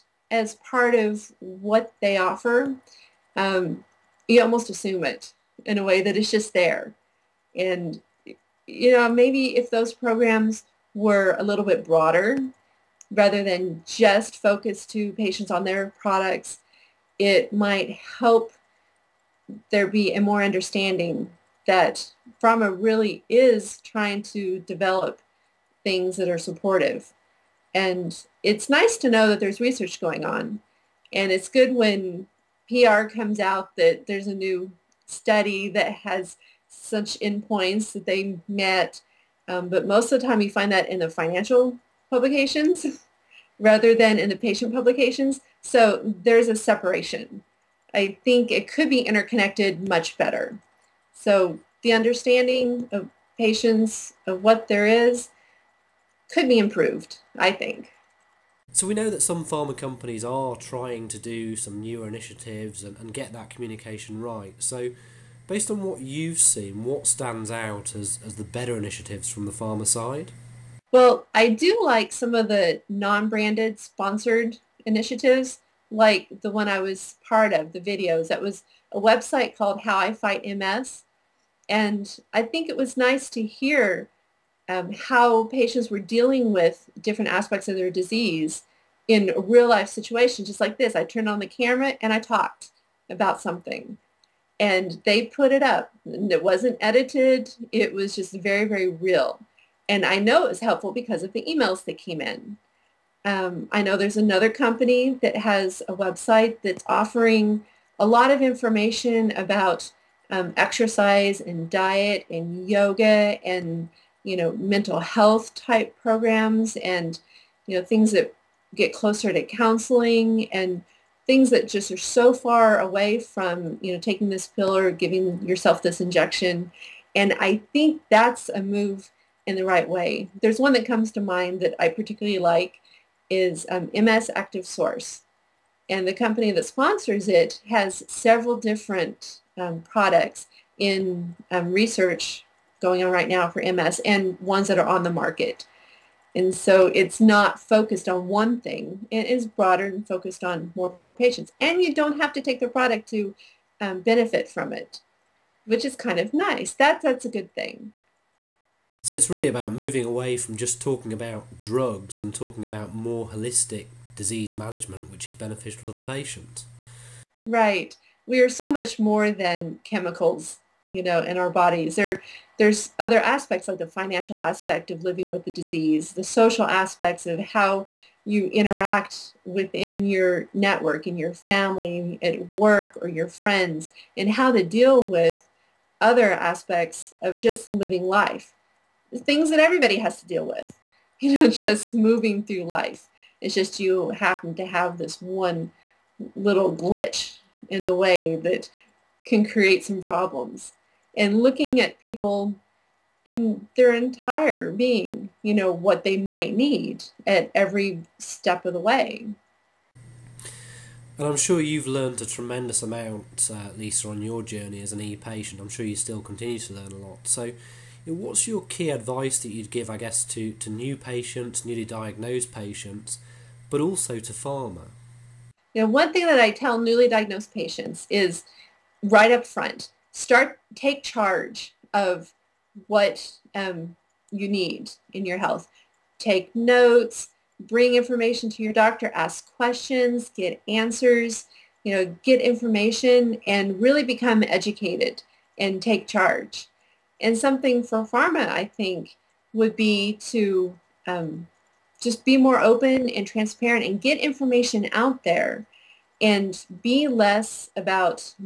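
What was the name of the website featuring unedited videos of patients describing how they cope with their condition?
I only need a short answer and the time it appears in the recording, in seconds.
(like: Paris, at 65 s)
How I Fight MS, at 79 s.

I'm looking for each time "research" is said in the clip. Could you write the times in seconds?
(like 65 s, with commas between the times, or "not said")
29 s, 141 s.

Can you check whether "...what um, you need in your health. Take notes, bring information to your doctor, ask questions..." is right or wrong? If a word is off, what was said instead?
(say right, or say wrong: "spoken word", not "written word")
right.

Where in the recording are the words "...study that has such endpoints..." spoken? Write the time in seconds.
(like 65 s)
35 s.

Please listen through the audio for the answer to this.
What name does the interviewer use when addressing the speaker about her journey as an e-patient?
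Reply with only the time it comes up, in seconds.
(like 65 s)
213 s.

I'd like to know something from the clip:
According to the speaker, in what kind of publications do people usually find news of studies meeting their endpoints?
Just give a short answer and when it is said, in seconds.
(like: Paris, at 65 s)
Financial publications, at 41 s.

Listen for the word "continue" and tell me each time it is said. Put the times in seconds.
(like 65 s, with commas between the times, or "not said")
216 s.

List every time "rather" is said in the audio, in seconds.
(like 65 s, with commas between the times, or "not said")
13 s, 43 s.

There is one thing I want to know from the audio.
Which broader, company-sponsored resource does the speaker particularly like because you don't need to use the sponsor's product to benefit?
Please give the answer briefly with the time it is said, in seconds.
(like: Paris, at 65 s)
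MS Active Source, at 133 s.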